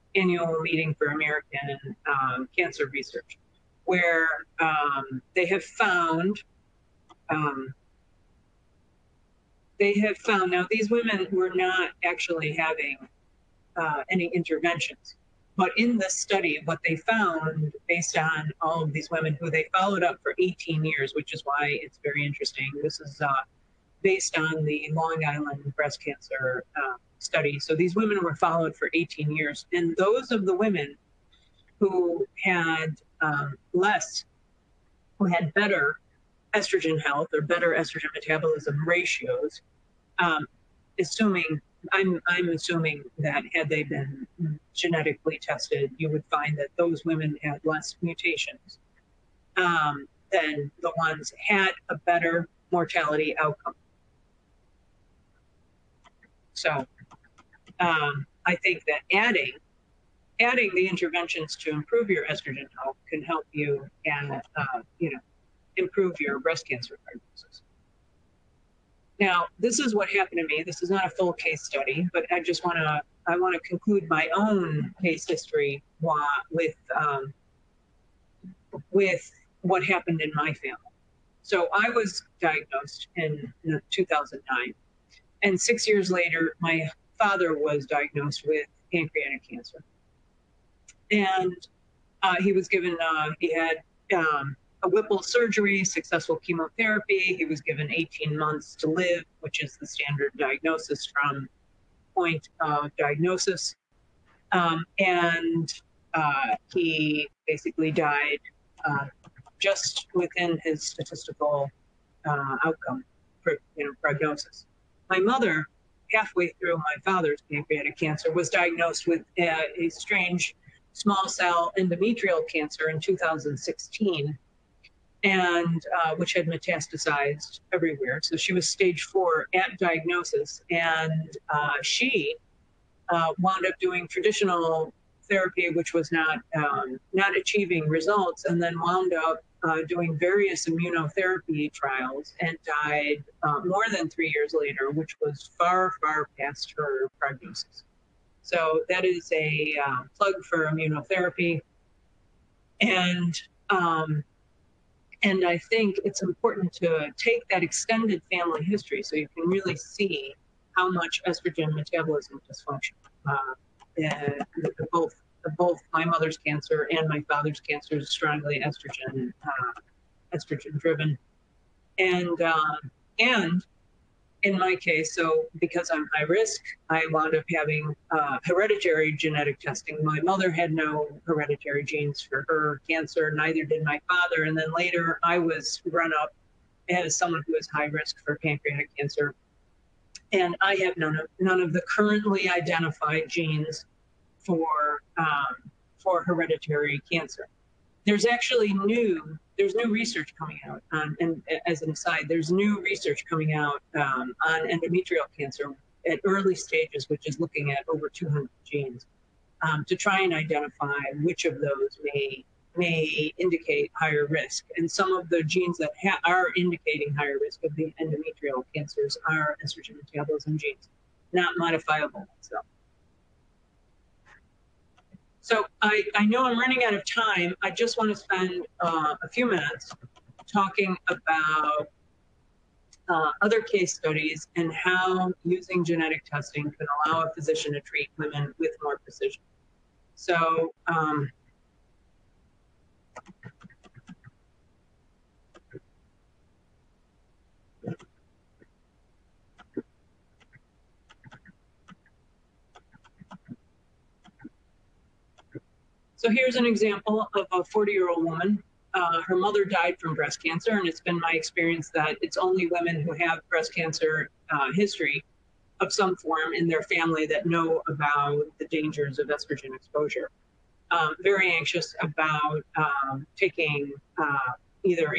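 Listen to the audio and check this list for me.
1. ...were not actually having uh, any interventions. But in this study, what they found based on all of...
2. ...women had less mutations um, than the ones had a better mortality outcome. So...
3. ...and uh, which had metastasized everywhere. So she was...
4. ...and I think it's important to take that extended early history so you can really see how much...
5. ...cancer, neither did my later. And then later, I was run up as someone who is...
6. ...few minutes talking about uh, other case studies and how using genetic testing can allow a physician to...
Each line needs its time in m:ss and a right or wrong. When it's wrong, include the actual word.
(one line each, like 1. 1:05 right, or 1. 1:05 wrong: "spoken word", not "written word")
1. 0:11 right
2. 0:47 right
3. 2:05 right
4. 2:35 wrong: "family", not "early"
5. 3:02 wrong: "father", not "later"
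6. 3:49 right.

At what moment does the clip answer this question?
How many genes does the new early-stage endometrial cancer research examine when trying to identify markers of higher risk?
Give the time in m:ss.
3:27.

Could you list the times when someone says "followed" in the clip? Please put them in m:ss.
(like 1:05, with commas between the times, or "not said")
0:19, 0:28.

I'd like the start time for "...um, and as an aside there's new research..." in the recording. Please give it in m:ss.
3:20.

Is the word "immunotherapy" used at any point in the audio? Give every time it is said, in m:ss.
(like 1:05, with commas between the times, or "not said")
2:20, 2:30.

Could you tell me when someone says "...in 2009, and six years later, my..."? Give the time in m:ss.
1:23.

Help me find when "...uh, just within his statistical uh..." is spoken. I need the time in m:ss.
1:48.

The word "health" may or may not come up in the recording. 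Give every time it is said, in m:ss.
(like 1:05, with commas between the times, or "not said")
0:37, 1:02.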